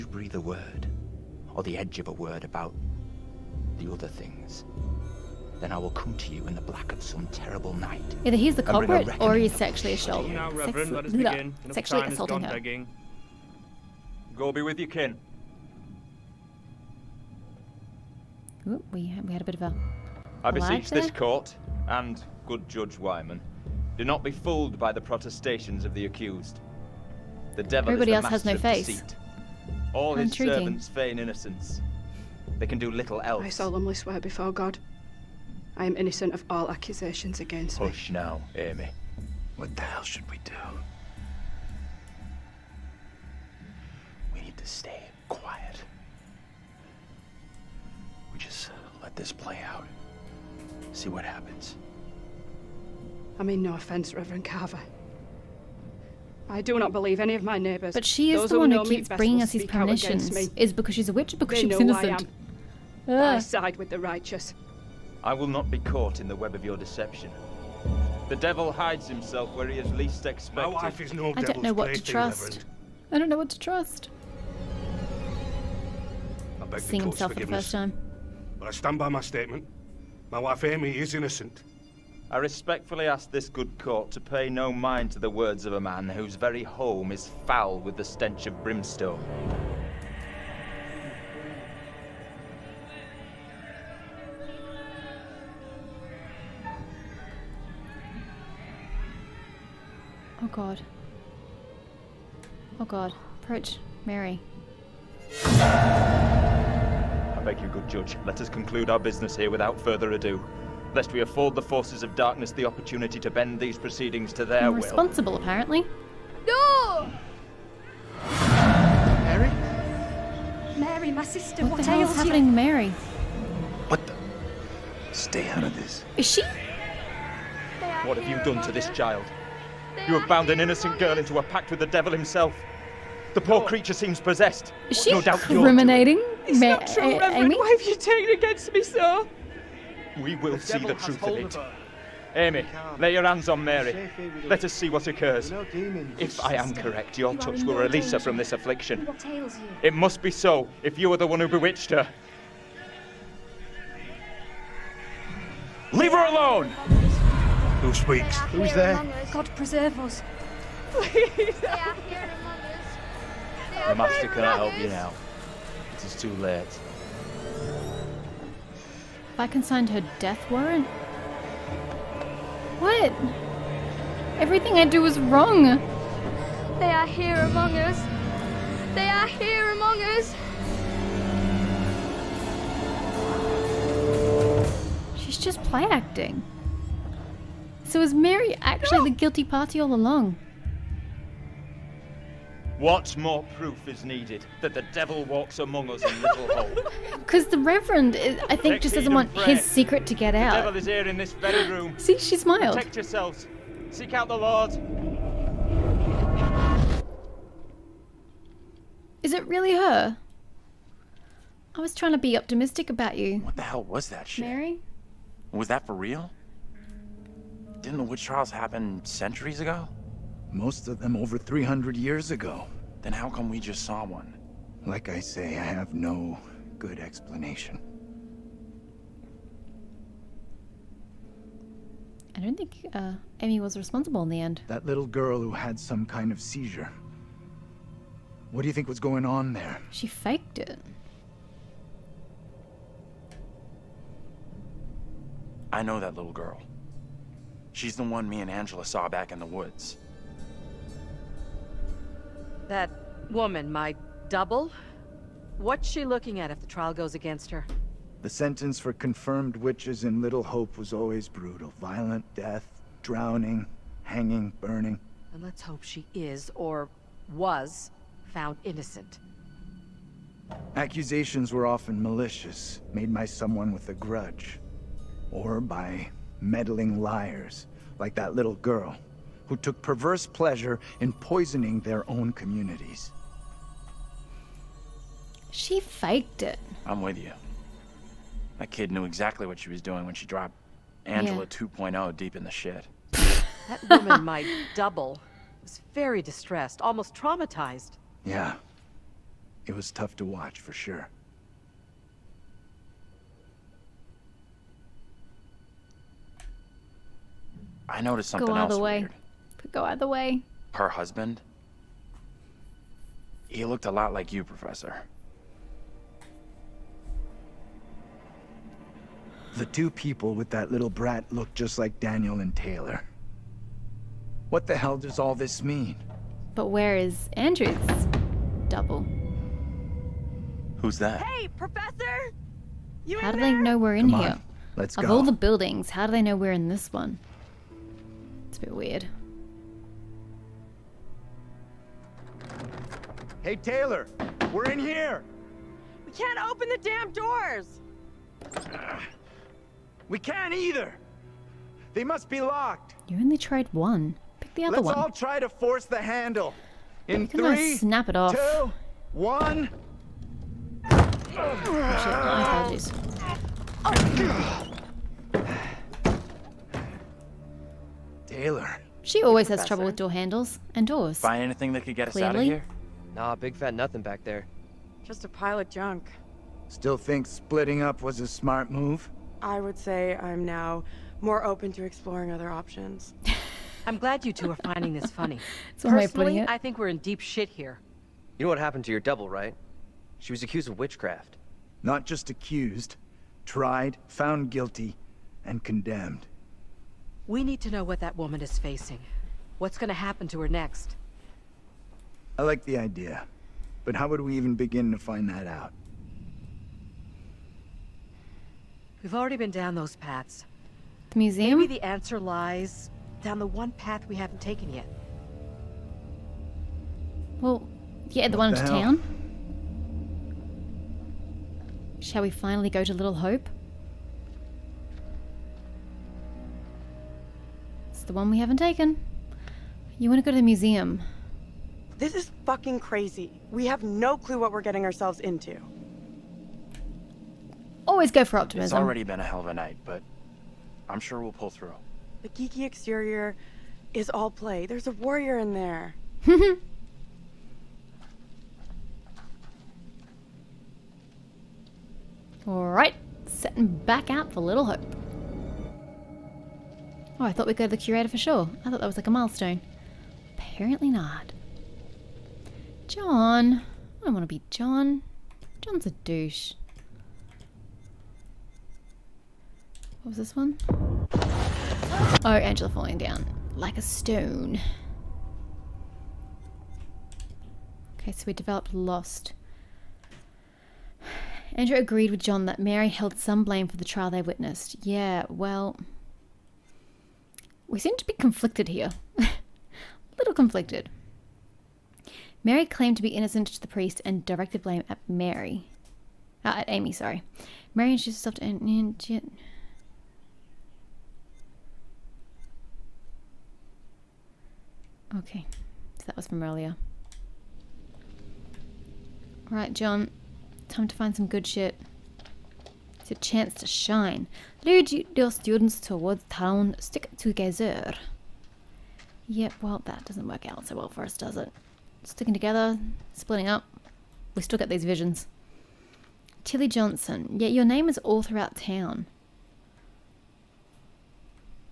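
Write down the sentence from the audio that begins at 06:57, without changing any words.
Well, yeah, the what one the to hell?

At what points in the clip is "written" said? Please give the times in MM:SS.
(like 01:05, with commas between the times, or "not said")
not said.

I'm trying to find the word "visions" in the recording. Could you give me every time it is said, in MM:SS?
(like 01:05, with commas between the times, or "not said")
08:44.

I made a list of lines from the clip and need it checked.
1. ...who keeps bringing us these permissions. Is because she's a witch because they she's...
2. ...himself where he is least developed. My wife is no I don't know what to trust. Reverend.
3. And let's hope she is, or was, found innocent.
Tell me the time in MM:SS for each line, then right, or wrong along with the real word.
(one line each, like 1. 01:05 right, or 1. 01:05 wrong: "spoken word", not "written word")
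1. 00:58 right
2. 01:09 wrong: "expected", not "developed"
3. 04:25 right.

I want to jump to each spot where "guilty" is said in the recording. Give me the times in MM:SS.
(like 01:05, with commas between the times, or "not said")
03:09, 06:34.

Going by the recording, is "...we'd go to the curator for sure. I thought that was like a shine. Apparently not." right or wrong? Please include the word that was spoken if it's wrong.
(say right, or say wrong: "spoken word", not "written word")
wrong: "milestone", not "shine".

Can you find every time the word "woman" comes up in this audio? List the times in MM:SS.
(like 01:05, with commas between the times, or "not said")
04:13, 04:53, 06:38.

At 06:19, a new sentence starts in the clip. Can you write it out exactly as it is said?
I would say I'm now more open to exploring other options.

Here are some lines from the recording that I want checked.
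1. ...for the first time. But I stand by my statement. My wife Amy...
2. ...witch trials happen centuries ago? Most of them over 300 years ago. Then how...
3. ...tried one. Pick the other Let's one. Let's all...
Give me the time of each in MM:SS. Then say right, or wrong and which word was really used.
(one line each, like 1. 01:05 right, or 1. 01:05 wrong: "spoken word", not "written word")
1. 01:17 right
2. 03:38 right
3. 05:53 right.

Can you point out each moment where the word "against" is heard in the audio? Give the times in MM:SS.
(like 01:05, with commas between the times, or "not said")
00:37, 02:18, 04:17.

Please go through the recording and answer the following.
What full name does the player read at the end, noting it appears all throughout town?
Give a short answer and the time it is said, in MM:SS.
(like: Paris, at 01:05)
Tilly Johnson, at 08:46.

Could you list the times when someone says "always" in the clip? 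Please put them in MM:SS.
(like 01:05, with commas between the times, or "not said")
04:20, 06:09, 07:17.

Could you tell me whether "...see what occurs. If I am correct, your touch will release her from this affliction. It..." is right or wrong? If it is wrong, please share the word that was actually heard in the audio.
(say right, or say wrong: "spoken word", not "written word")
right.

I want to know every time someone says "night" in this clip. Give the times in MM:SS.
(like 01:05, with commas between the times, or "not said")
00:07, 07:19.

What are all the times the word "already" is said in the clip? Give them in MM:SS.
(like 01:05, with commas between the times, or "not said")
06:49, 07:18.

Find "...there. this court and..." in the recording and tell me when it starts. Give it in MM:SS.
00:20.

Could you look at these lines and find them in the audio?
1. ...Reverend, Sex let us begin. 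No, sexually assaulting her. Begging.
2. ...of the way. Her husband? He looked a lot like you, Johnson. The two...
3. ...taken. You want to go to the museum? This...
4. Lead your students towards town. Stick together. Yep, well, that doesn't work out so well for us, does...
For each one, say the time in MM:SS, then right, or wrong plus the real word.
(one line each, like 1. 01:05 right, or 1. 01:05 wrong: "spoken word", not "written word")
1. 00:10 right
2. 05:09 wrong: "Professor", not "Johnson"
3. 07:08 right
4. 08:34 right.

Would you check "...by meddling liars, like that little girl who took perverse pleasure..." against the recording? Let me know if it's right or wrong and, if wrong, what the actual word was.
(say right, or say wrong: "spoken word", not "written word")
right.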